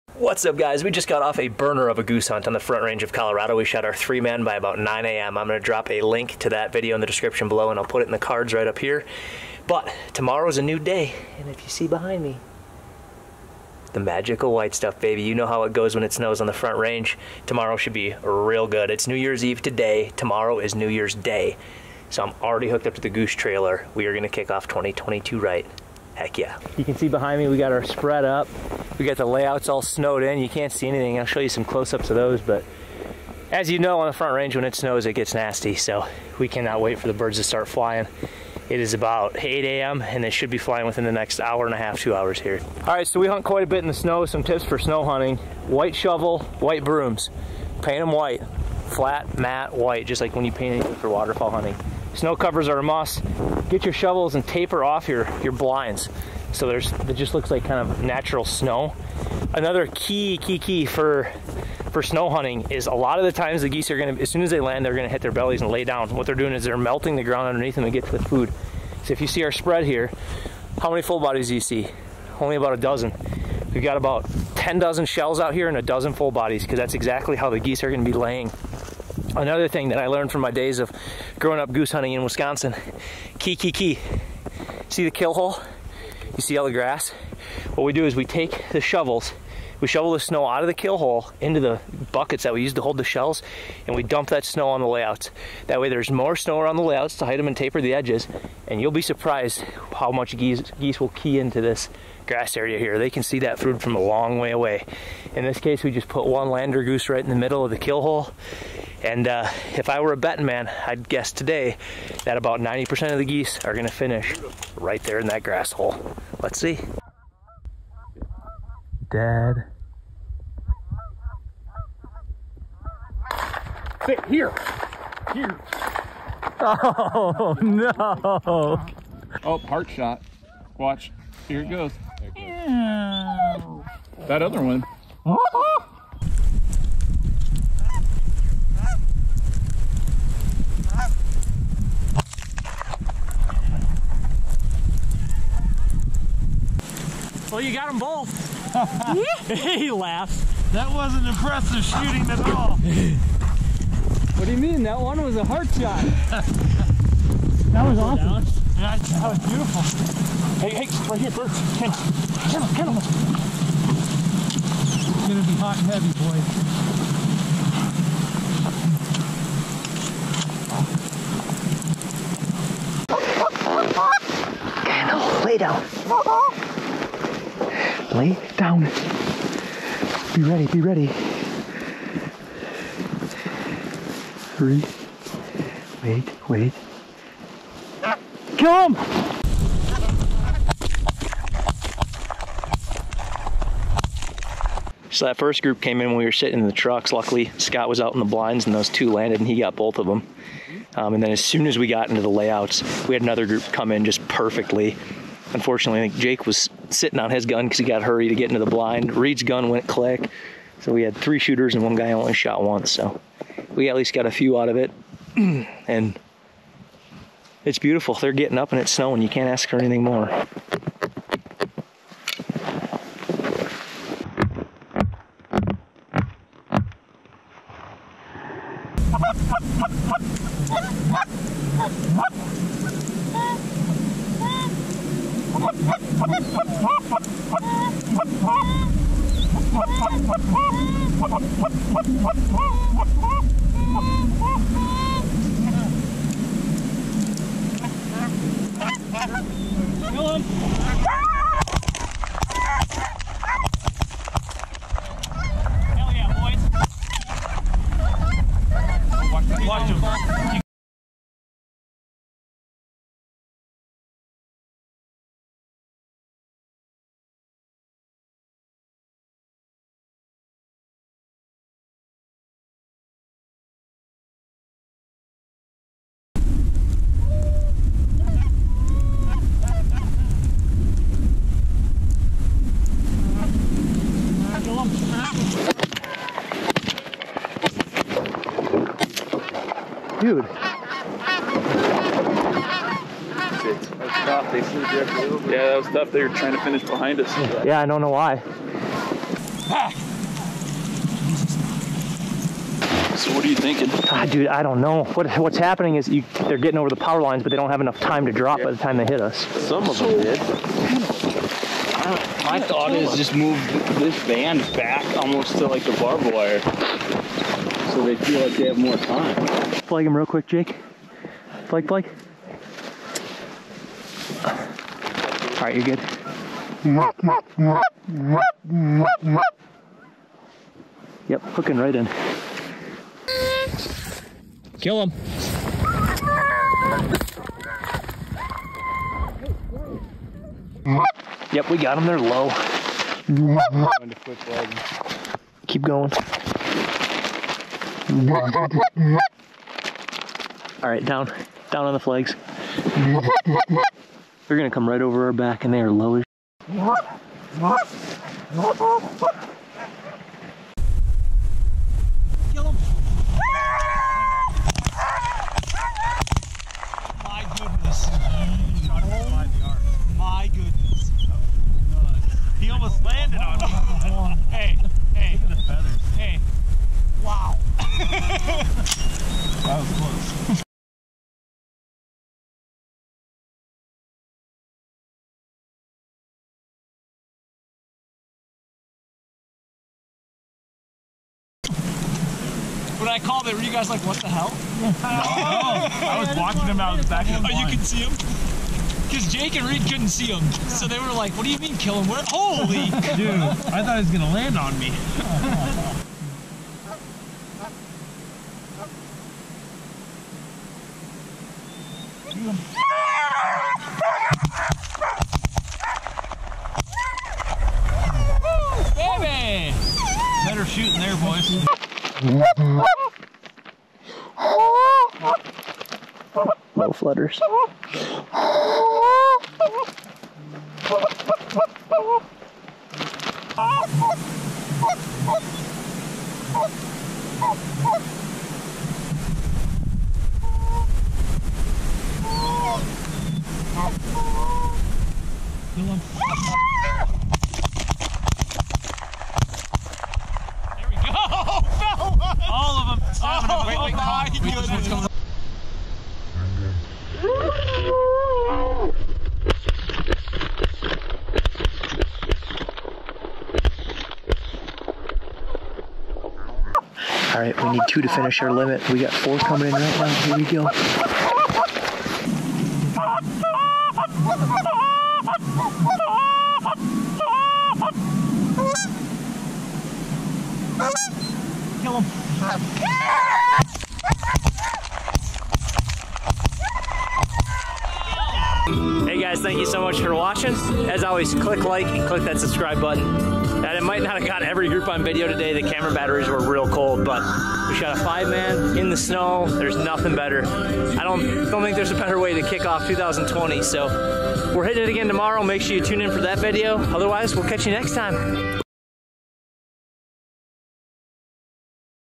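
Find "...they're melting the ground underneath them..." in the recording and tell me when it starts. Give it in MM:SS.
01:06.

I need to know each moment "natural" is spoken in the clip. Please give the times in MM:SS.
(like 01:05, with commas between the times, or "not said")
00:58.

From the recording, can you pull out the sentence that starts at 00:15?
You know how it goes when it snows on the front range.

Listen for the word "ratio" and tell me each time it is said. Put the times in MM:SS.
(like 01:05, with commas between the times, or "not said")
not said.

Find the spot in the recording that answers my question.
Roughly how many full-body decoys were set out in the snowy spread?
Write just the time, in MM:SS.
01:12.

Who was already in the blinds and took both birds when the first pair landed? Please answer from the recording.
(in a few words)
Scott.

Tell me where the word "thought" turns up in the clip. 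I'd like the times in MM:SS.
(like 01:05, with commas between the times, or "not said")
05:12, 06:43.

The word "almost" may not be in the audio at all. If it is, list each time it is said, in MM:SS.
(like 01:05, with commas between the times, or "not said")
05:15, 06:12.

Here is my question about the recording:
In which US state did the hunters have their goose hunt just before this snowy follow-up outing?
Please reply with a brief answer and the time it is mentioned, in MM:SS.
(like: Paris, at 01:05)
Colorado, at 00:03.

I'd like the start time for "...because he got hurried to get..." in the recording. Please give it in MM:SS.
03:27.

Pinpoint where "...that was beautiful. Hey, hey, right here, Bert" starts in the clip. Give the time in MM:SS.
02:38.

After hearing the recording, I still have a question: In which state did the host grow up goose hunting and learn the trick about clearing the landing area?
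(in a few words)
Wisconsin.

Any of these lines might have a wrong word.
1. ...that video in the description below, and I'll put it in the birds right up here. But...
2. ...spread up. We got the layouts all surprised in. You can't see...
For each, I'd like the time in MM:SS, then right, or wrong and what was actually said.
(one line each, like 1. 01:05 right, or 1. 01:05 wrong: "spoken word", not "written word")
1. 00:06 wrong: "cards", not "birds"
2. 00:27 wrong: "snowed", not "surprised".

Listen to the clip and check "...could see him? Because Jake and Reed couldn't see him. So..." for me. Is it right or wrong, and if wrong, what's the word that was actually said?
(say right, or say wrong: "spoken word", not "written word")
right.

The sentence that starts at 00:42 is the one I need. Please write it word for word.
All right, so we hunt quite a bit in the snow.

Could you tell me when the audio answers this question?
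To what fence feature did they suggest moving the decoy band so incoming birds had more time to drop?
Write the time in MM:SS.
05:15.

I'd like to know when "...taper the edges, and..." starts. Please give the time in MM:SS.
01:37.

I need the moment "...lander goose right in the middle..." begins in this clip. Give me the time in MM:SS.
01:46.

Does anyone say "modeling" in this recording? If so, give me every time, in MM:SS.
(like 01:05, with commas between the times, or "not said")
not said.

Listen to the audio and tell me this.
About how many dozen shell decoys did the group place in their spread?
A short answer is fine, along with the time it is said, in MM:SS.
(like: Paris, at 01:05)
10 dozen, at 01:14.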